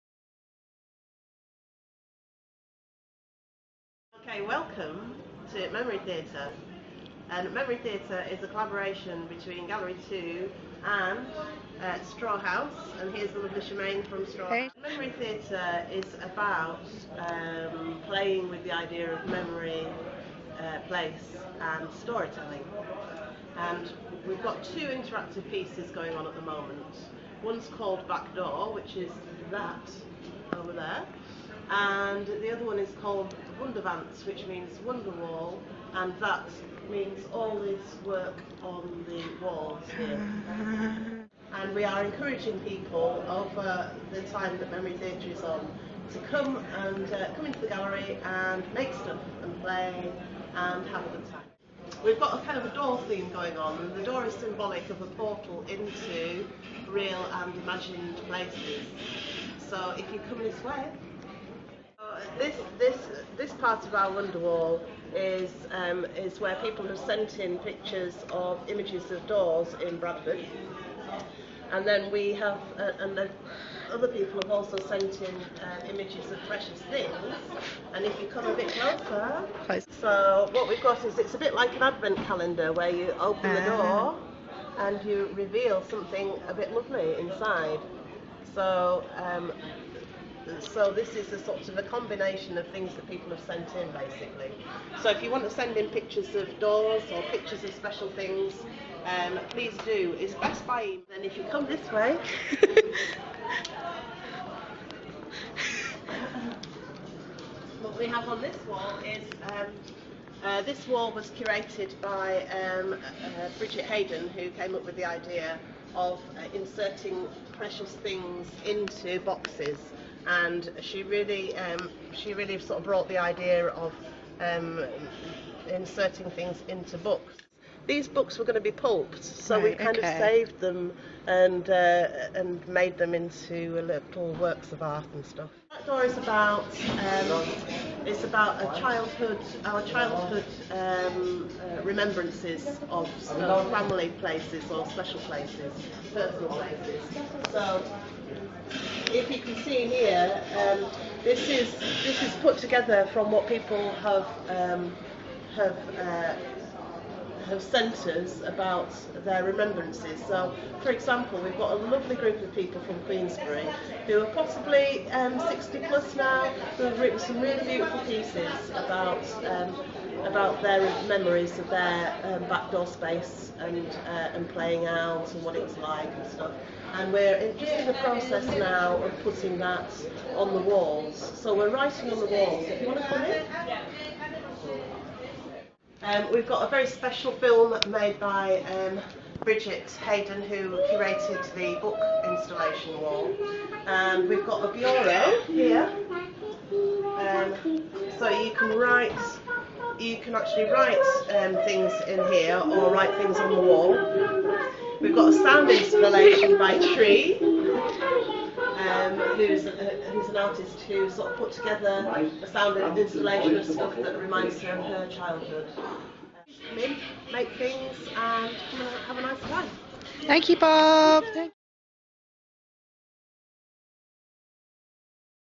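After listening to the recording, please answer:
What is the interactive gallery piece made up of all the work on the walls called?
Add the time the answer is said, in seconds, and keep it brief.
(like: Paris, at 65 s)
Wunderwand, at 33 s.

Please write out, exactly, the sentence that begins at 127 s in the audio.
These books were going to be pulped, so right, we kind okay.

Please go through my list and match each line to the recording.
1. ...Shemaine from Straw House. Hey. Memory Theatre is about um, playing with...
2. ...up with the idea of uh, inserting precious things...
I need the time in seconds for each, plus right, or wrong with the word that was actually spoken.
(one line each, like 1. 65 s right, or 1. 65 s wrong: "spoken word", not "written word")
1. 13 s right
2. 114 s right.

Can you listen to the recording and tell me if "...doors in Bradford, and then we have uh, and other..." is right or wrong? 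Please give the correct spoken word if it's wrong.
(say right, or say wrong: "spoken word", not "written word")
right.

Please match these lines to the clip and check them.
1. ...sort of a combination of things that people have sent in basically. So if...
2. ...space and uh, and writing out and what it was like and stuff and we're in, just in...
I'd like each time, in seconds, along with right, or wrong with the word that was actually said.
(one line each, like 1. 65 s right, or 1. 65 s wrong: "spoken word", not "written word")
1. 91 s right
2. 172 s wrong: "playing", not "writing".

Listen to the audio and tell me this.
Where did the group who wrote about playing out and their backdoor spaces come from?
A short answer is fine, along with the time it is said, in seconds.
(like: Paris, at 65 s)
Queensbury, at 163 s.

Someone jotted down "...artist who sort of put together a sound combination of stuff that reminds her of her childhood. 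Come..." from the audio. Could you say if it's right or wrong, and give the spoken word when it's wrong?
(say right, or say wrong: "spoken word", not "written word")
wrong: "installation", not "combination".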